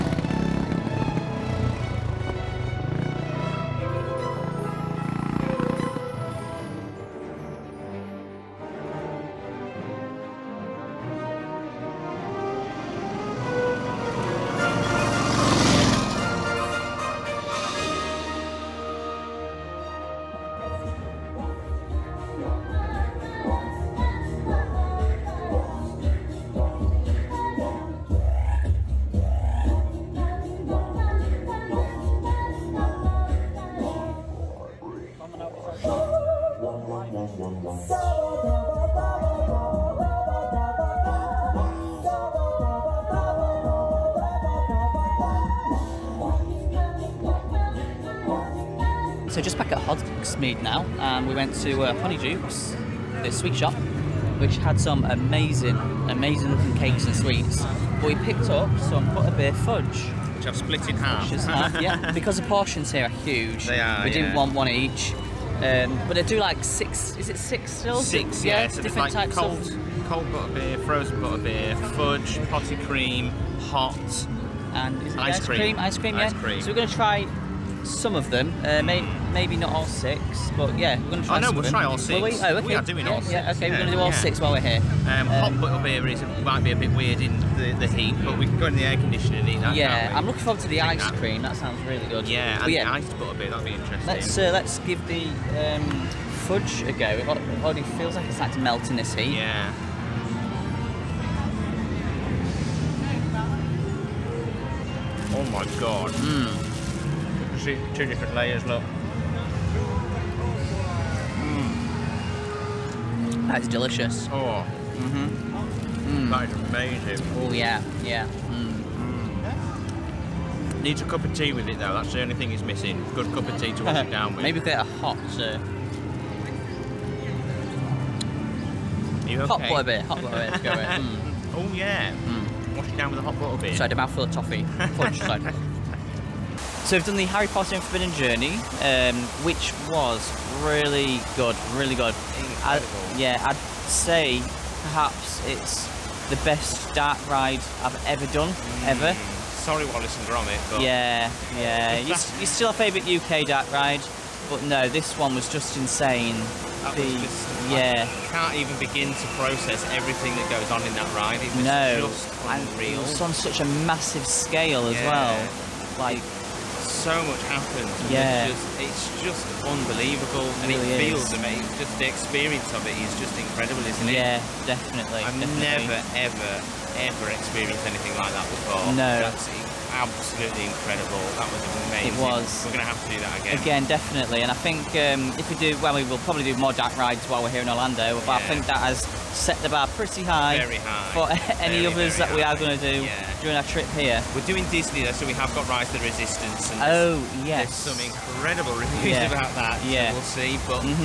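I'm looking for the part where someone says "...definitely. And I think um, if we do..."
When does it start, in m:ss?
3:03.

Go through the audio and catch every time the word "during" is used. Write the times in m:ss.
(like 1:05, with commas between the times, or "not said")
3:13.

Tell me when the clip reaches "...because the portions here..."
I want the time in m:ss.
1:02.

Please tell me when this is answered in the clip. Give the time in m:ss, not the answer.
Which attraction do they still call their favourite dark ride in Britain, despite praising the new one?
2:29.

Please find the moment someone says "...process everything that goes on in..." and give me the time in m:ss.
2:39.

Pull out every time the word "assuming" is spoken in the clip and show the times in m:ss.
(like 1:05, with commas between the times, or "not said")
not said.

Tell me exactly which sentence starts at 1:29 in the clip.
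Yeah, I'm looking forward to the ice that.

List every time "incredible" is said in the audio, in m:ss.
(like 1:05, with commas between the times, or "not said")
2:53, 3:00, 3:18.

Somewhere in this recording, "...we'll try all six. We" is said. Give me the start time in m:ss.
1:21.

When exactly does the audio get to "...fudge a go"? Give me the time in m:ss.
1:36.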